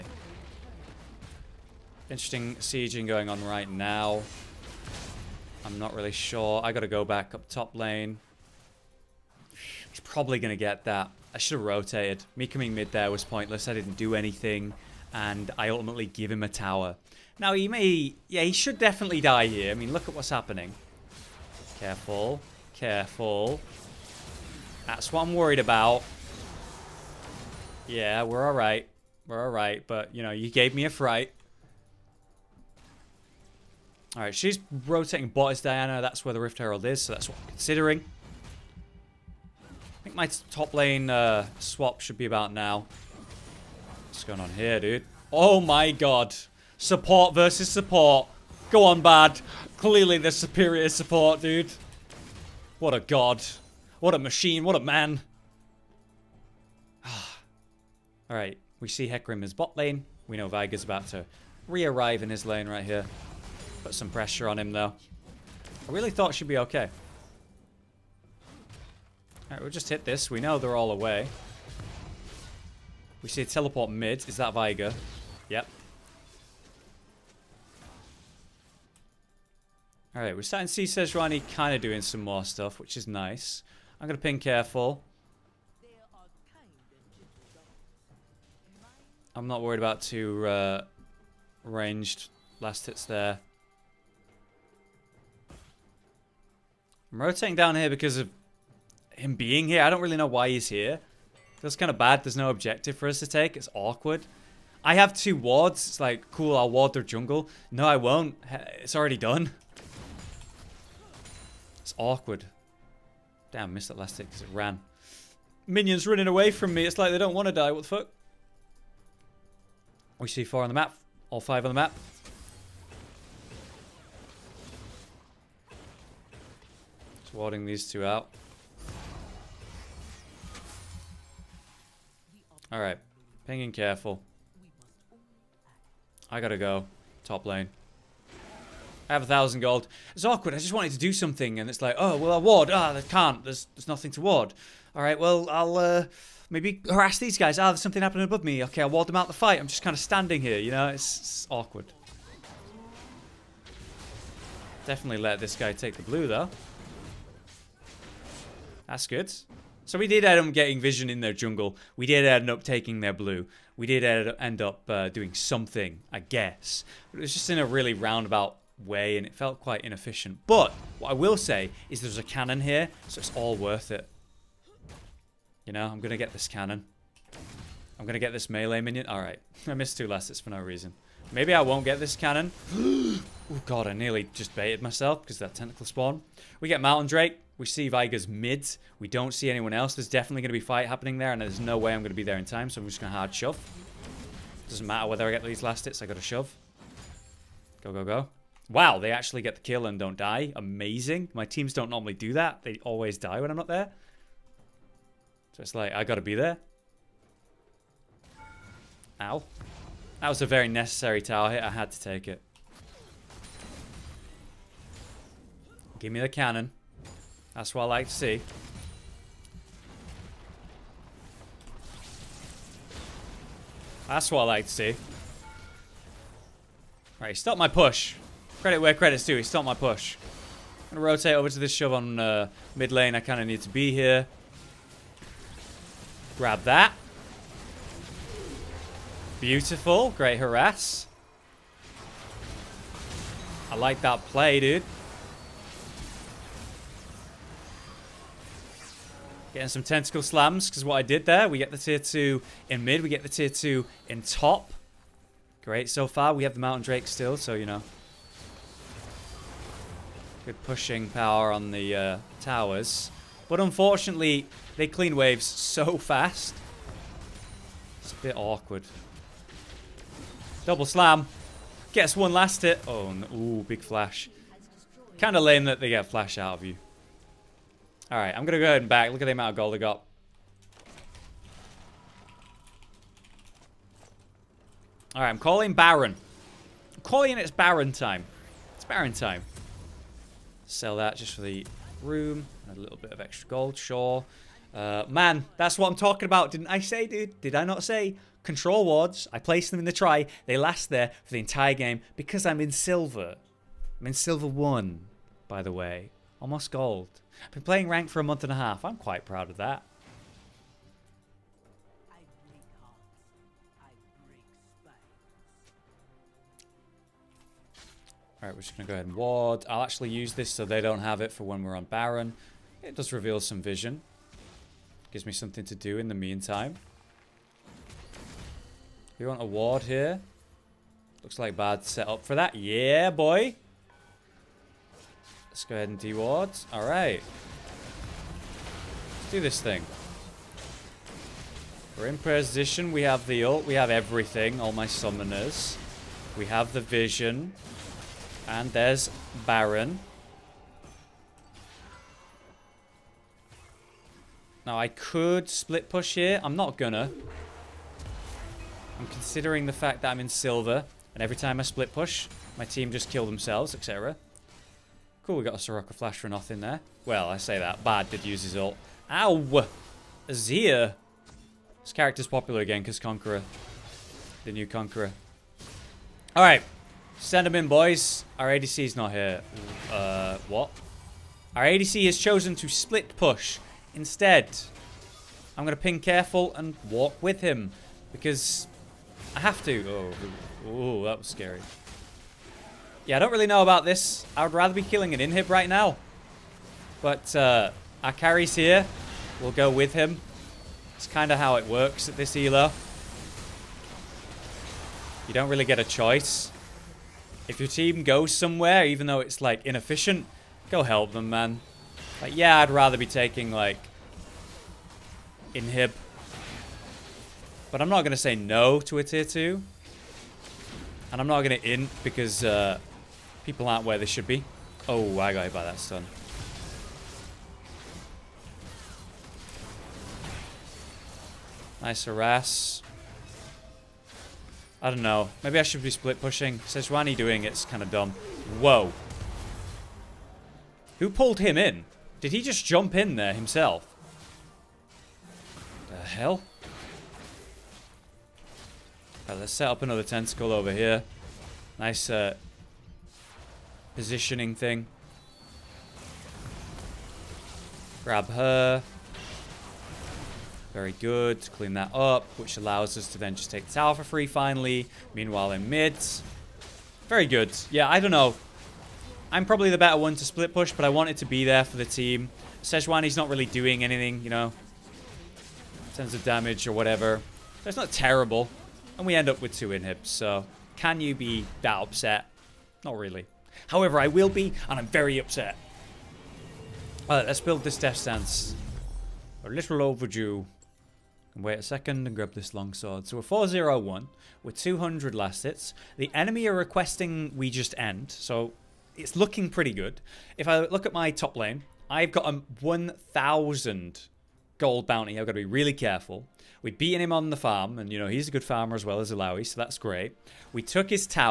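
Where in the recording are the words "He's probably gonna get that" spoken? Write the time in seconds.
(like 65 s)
9 s.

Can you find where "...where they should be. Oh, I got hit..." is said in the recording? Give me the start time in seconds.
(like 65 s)
423 s.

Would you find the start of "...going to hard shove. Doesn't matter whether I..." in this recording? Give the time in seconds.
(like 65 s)
193 s.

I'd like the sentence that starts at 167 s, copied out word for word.
But it was just in a really roundabout way and it felt quite inefficient.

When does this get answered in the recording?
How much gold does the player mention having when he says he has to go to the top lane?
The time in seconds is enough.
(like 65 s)
139 s.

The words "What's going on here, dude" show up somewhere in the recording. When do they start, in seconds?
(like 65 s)
44 s.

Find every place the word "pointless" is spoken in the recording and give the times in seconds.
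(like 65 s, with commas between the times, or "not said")
13 s.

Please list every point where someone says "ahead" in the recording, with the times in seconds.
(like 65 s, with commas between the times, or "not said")
278 s, 318 s, 335 s.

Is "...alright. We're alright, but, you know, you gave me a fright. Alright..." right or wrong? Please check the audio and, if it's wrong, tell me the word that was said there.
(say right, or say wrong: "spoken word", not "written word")
right.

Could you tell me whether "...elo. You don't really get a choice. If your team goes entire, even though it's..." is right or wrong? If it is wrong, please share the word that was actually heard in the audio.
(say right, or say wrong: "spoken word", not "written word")
wrong: "somewhere", not "entire".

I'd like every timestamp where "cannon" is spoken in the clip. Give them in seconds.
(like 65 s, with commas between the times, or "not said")
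172 s, 176 s, 182 s, 216 s.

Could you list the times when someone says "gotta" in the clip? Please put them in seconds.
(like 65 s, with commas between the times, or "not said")
6 s, 136 s, 206 s.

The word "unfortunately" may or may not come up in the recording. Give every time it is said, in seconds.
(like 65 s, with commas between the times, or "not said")
263 s.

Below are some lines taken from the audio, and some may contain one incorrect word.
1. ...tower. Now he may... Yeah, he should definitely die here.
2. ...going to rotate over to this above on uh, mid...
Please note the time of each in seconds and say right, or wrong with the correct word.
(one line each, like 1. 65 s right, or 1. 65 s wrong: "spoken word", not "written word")
1. 16 s right
2. 230 s wrong: "shove", not "above".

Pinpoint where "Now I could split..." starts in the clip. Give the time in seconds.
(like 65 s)
354 s.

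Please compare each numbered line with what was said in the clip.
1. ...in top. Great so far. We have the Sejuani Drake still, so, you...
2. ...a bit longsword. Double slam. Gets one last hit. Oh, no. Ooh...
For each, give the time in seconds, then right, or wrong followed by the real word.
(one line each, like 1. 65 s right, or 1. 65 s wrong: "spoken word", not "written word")
1. 254 s wrong: "Mountain", not "Sejuani"
2. 268 s wrong: "awkward", not "longsword".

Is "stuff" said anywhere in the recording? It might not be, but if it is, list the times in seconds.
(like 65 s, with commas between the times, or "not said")
82 s.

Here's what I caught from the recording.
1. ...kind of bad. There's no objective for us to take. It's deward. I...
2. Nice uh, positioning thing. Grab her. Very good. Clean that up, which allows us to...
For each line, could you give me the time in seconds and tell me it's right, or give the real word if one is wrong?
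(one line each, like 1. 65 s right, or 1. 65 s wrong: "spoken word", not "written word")
1. 101 s wrong: "awkward", not "deward"
2. 451 s right.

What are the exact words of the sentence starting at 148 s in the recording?
Okay, I'll ward them out the fight.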